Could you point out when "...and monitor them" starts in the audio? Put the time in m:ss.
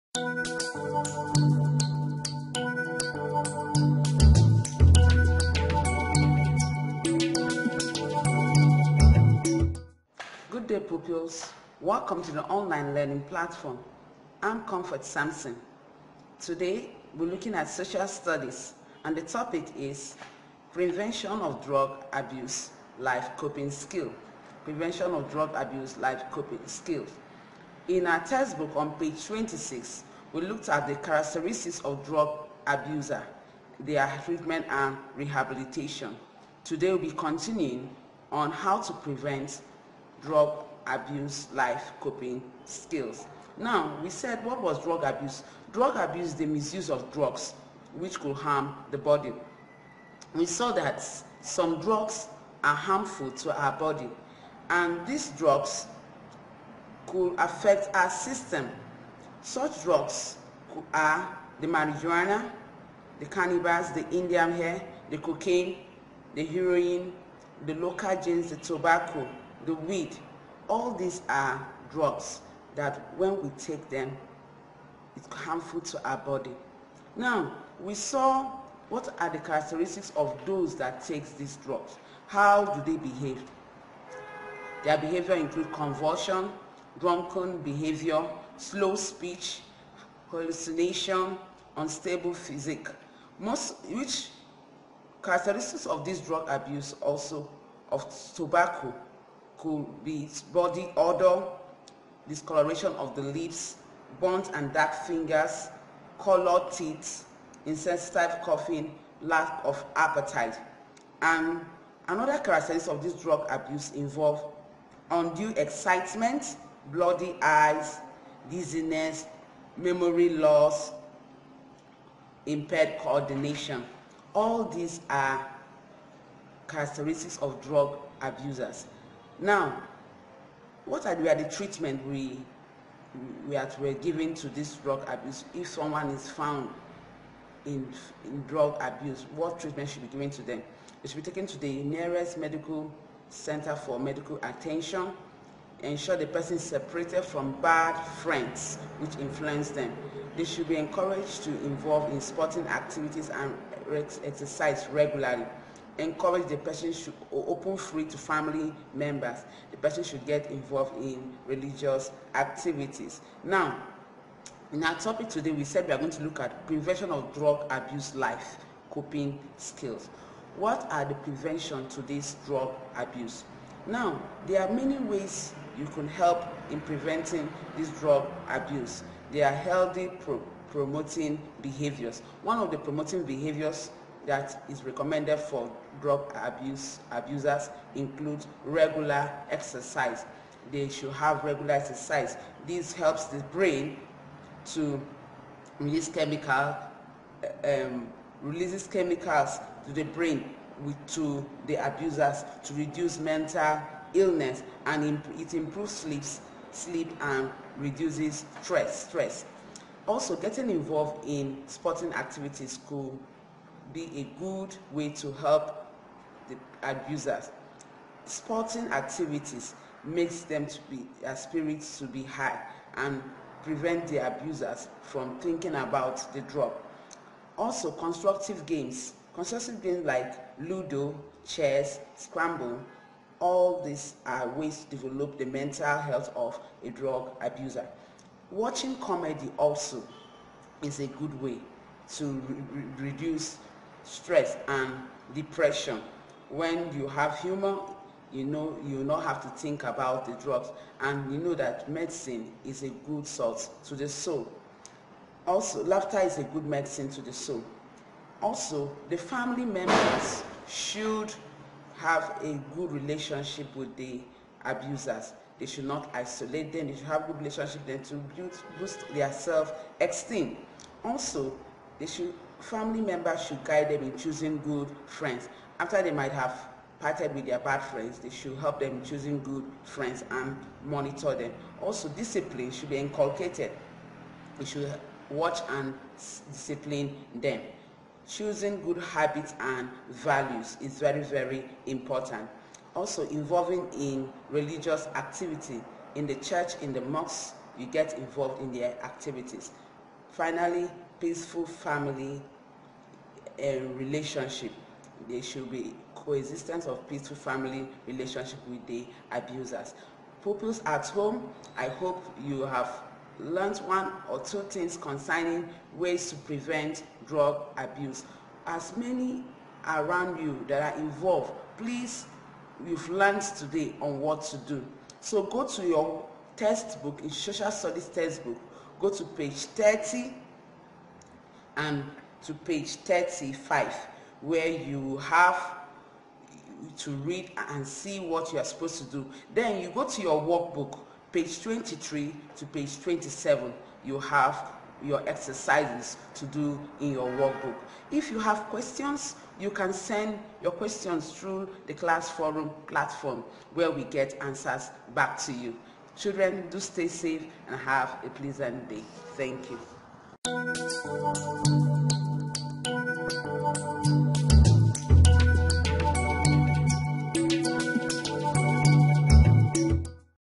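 4:40.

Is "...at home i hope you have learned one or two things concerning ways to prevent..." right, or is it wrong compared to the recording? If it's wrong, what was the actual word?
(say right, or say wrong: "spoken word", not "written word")
right.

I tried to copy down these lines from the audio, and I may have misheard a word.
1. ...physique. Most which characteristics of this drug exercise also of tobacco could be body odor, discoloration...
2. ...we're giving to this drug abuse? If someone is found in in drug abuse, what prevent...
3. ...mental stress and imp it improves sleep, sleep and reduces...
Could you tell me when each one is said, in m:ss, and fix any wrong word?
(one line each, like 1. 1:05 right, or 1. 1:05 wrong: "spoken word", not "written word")
1. 1:32 wrong: "abuse", not "exercise"
2. 2:13 wrong: "treatment", not "prevent"
3. 3:23 wrong: "illness", not "stress".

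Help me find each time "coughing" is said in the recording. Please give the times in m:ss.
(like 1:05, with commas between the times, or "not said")
1:48.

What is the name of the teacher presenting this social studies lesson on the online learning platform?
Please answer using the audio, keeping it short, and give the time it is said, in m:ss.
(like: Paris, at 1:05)
Comfort Sampson, at 0:14.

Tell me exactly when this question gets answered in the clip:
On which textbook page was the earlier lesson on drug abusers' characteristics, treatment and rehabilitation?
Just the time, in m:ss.
0:28.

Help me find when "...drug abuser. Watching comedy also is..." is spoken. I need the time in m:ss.
3:56.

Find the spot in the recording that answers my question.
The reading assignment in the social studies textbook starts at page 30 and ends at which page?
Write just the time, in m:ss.
5:32.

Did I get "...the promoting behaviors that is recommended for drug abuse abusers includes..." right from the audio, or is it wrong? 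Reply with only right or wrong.
right.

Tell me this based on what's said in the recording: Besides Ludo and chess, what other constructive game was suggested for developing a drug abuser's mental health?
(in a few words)
Scramble.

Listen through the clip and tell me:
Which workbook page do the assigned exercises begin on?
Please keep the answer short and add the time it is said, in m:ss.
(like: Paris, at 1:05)
23, at 5:41.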